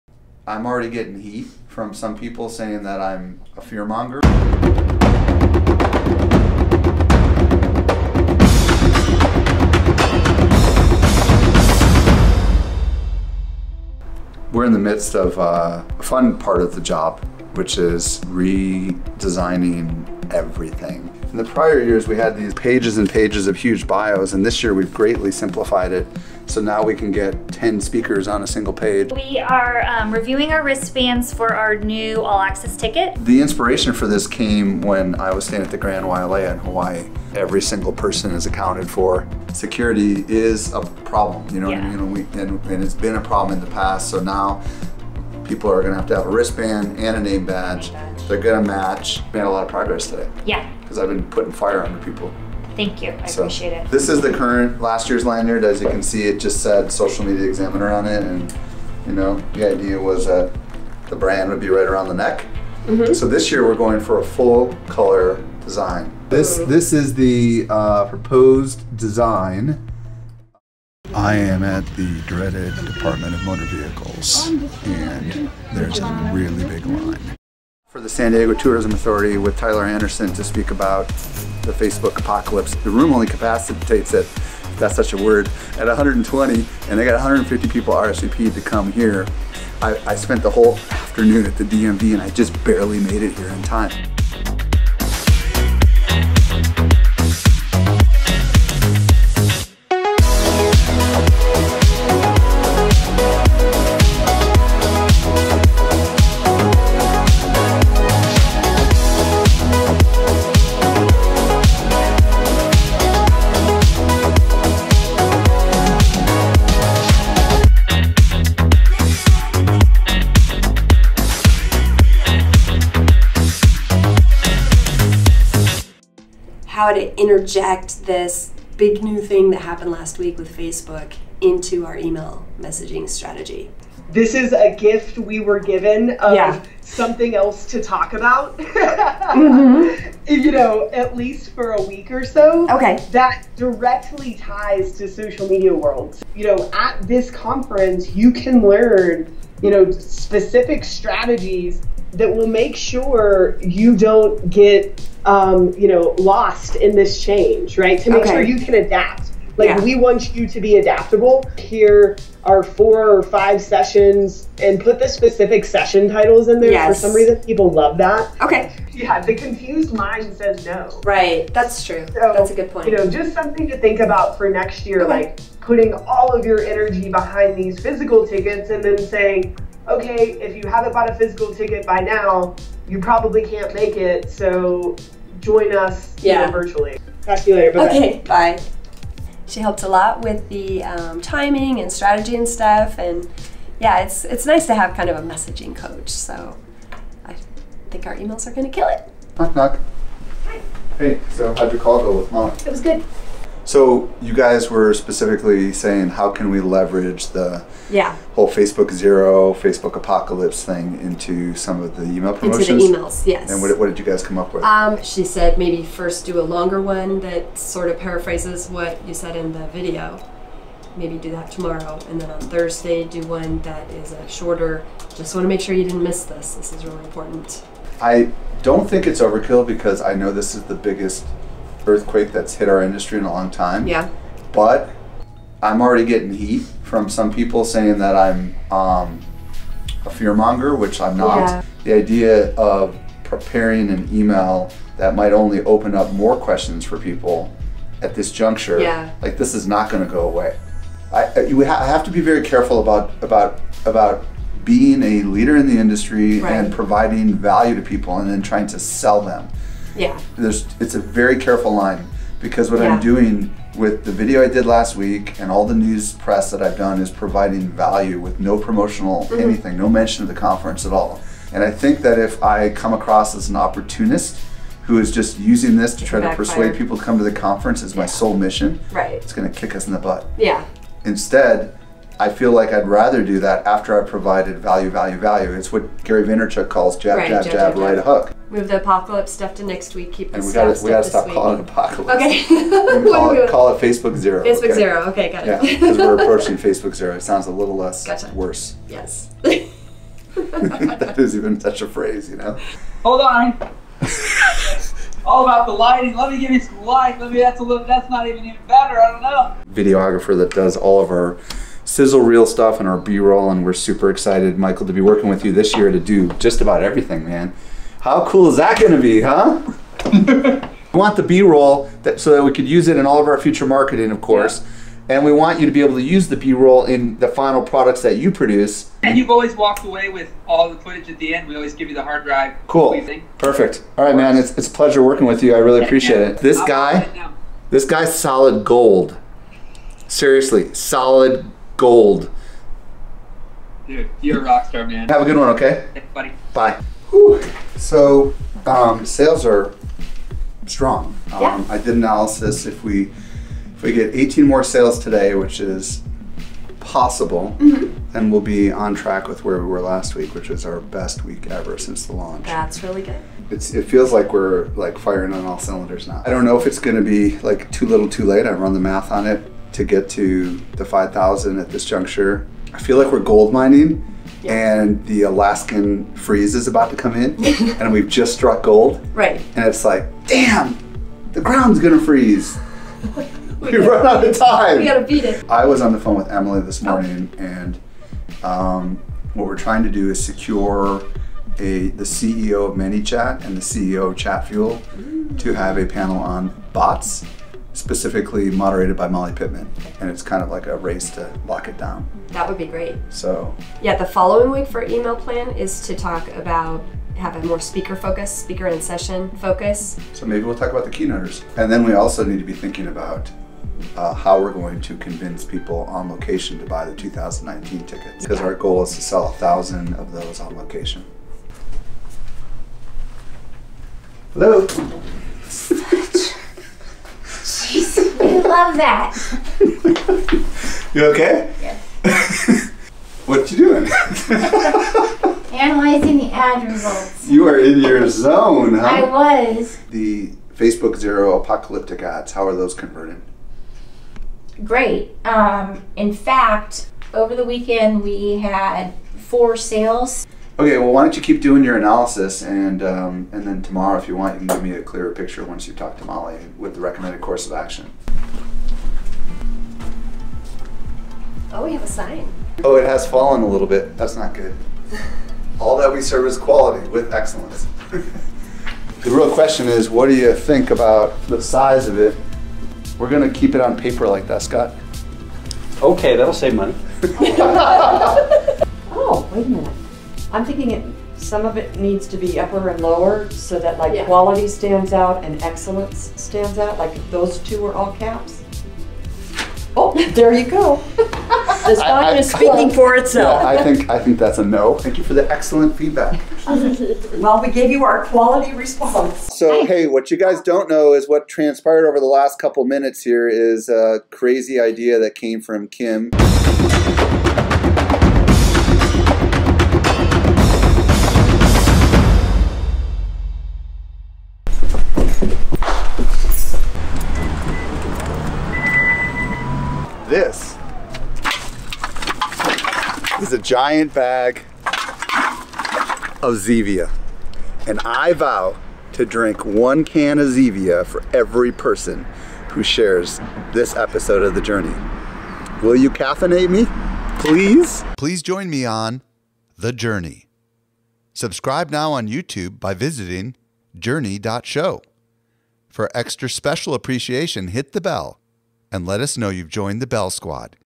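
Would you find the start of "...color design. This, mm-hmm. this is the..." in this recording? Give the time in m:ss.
1:04.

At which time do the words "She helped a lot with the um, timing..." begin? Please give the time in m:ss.
3:09.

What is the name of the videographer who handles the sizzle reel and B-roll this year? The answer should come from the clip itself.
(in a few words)
Michael.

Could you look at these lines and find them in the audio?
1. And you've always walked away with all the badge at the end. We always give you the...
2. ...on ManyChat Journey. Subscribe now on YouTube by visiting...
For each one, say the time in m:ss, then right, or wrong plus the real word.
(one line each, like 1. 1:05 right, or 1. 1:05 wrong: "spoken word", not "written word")
1. 5:29 wrong: "footage", not "badge"
2. 8:58 wrong: "The", not "ManyChat".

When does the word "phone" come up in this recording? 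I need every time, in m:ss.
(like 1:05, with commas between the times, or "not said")
6:25.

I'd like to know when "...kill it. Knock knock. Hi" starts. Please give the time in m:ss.
3:18.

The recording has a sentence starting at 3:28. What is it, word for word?
whole Facebook Zero, Facebook Apocalypse thing into some of the email promotions?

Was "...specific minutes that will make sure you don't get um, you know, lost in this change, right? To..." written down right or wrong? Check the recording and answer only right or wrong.
wrong.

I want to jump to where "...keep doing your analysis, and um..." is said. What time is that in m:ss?
7:31.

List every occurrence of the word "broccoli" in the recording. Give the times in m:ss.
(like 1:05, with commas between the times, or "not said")
not said.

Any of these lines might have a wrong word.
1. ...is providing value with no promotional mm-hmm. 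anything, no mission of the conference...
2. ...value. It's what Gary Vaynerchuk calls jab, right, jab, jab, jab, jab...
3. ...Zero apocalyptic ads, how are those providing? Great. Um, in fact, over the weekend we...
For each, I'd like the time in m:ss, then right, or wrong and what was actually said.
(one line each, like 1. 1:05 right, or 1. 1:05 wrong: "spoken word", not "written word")
1. 4:27 wrong: "mention", not "mission"
2. 4:45 right
3. 7:20 wrong: "converting", not "providing".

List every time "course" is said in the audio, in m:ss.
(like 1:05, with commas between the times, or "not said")
5:24, 7:37.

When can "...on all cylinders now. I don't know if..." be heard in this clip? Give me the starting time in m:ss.
6:05.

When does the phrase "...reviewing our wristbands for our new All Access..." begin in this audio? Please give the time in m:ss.
0:30.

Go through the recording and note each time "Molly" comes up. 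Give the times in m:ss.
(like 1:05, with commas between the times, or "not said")
6:39, 7:36.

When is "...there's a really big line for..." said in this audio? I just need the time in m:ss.
1:15.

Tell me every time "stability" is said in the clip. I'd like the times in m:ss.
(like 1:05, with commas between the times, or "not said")
not said.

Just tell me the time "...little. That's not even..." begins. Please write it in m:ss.
5:07.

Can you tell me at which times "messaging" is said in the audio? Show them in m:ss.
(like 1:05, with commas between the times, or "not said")
2:12, 3:15.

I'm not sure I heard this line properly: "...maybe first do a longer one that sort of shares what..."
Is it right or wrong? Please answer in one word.
wrong.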